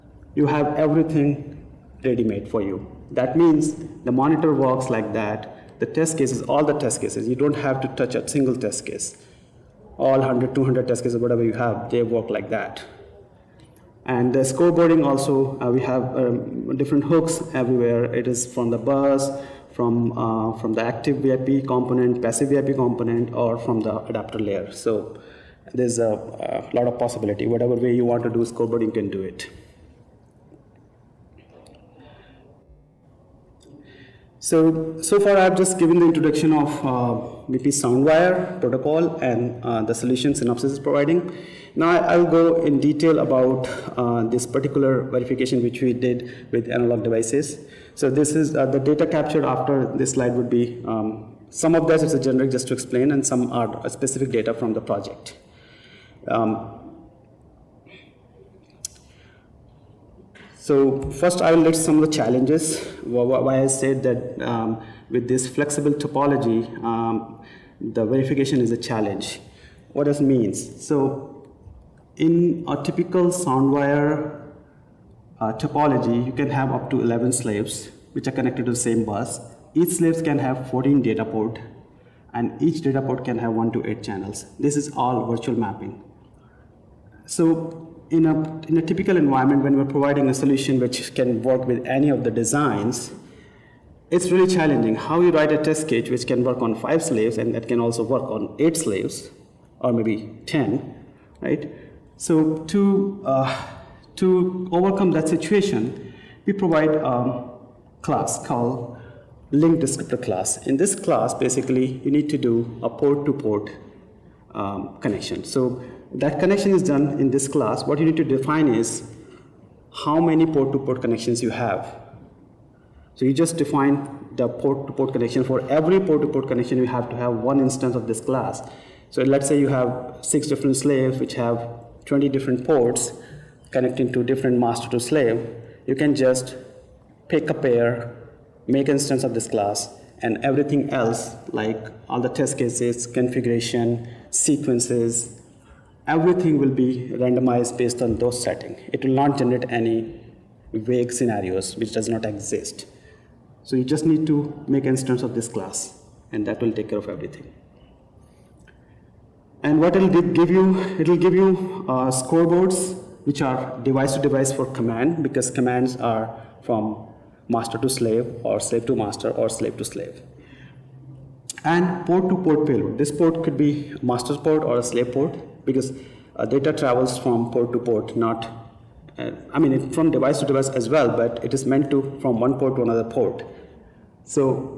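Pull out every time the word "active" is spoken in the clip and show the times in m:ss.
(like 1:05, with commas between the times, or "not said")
0:20.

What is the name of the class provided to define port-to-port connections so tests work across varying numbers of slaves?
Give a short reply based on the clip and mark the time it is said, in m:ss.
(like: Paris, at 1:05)
link descriptor class, at 1:49.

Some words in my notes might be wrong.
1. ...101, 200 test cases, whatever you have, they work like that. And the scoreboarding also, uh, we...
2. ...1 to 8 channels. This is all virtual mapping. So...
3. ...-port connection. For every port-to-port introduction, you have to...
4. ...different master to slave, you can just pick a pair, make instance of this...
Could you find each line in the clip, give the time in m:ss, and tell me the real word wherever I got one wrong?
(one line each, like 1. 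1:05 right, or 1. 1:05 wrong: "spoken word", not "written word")
1. 0:10 wrong: "100", not "101"
2. 1:23 right
3. 2:04 wrong: "connection", not "introduction"
4. 2:14 right.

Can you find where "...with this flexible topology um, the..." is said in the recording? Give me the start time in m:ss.
1:05.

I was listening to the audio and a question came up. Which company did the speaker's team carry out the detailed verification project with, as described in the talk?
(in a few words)
Analog Devices.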